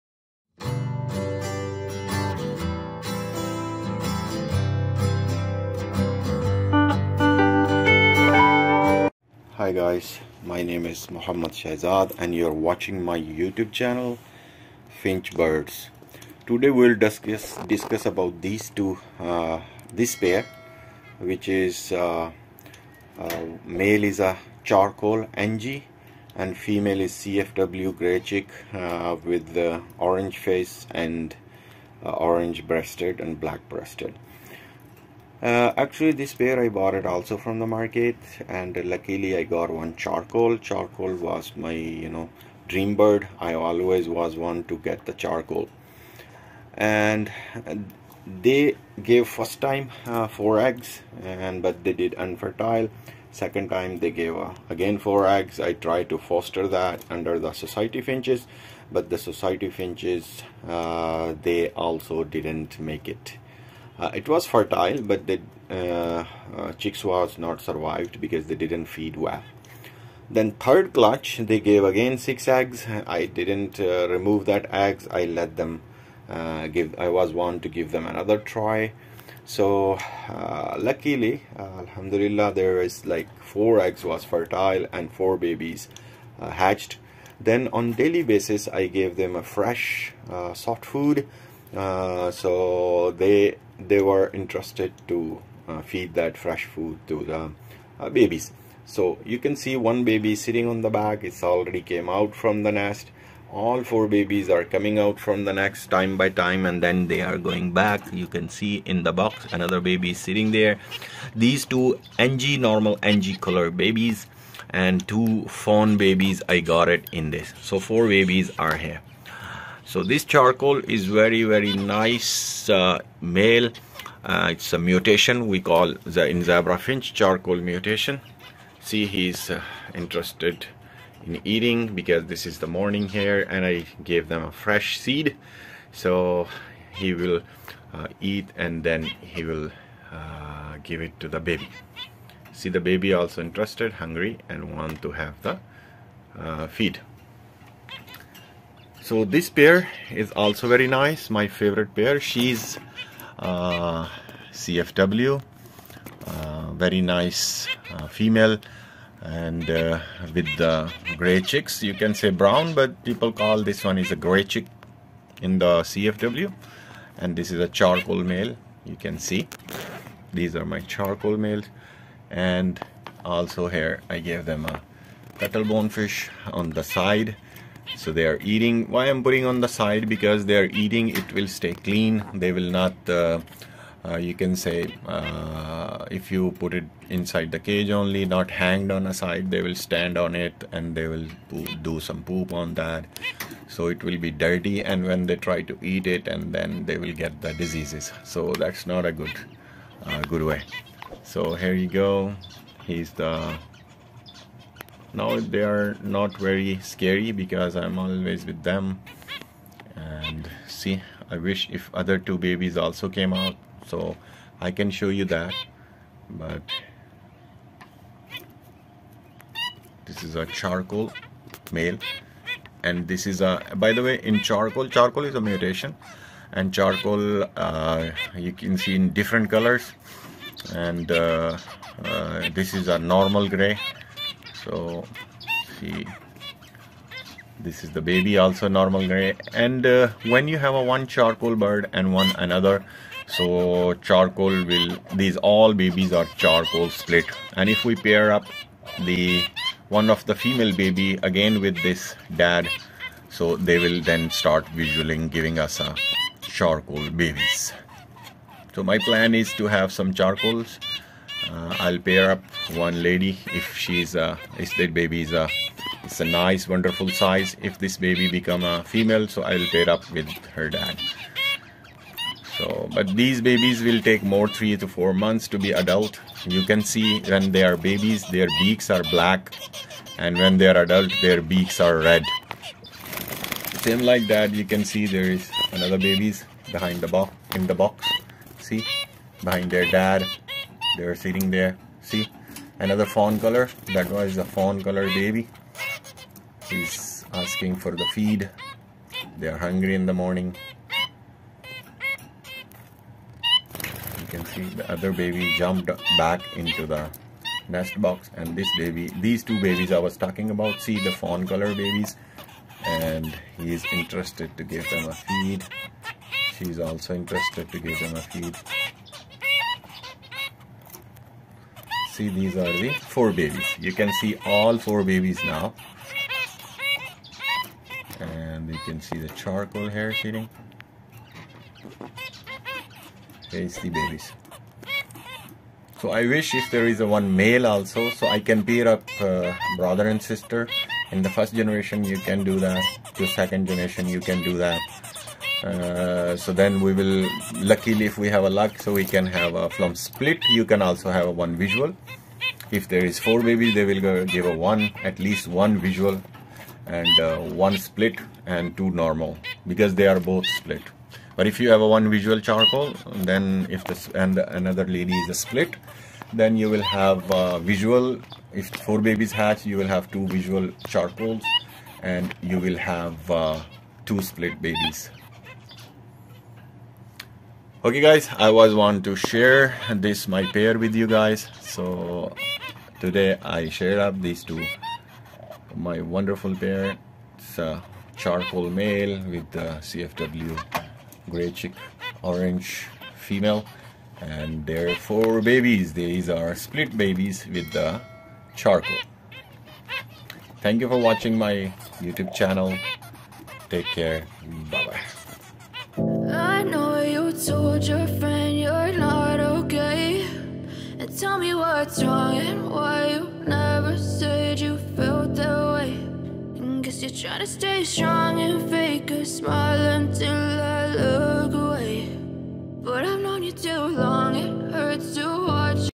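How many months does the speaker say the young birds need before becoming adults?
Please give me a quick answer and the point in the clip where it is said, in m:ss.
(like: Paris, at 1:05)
3 to 4 months, at 4:34.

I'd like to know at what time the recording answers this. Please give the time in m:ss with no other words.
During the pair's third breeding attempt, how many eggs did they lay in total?
1:12.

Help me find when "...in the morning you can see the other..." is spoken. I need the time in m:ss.
4:59.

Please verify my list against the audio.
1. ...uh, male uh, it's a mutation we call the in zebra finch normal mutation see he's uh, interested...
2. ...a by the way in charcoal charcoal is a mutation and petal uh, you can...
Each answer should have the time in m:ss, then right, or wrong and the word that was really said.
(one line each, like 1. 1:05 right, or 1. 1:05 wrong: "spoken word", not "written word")
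1. 2:02 wrong: "charcoal", not "normal"
2. 3:43 wrong: "charcoal", not "petal".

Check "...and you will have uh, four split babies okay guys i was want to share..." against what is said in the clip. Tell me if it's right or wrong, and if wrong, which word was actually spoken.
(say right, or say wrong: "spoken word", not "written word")
wrong: "two", not "four".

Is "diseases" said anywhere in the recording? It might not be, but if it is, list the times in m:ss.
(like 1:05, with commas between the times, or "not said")
3:17.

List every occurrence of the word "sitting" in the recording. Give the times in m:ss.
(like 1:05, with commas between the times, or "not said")
1:40, 1:50, 4:51, 5:30.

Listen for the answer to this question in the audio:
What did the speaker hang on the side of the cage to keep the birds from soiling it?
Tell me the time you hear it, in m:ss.
2:55.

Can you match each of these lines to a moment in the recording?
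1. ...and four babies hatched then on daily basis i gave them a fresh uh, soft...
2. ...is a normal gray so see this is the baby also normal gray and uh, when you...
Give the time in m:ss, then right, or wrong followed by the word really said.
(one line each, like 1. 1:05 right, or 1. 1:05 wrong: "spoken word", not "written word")
1. 1:24 right
2. 3:52 right.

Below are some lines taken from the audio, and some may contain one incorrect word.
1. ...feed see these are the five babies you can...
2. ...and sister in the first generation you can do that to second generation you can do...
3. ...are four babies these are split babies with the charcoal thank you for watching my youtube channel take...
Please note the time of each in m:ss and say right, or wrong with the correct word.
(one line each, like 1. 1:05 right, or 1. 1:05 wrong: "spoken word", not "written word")
1. 5:18 wrong: "four", not "five"
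2. 5:40 right
3. 6:34 right.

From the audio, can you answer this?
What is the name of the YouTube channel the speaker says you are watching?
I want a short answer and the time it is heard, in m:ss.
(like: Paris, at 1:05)
Finch Birds, at 0:15.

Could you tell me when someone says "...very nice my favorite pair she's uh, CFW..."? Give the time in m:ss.
2:30.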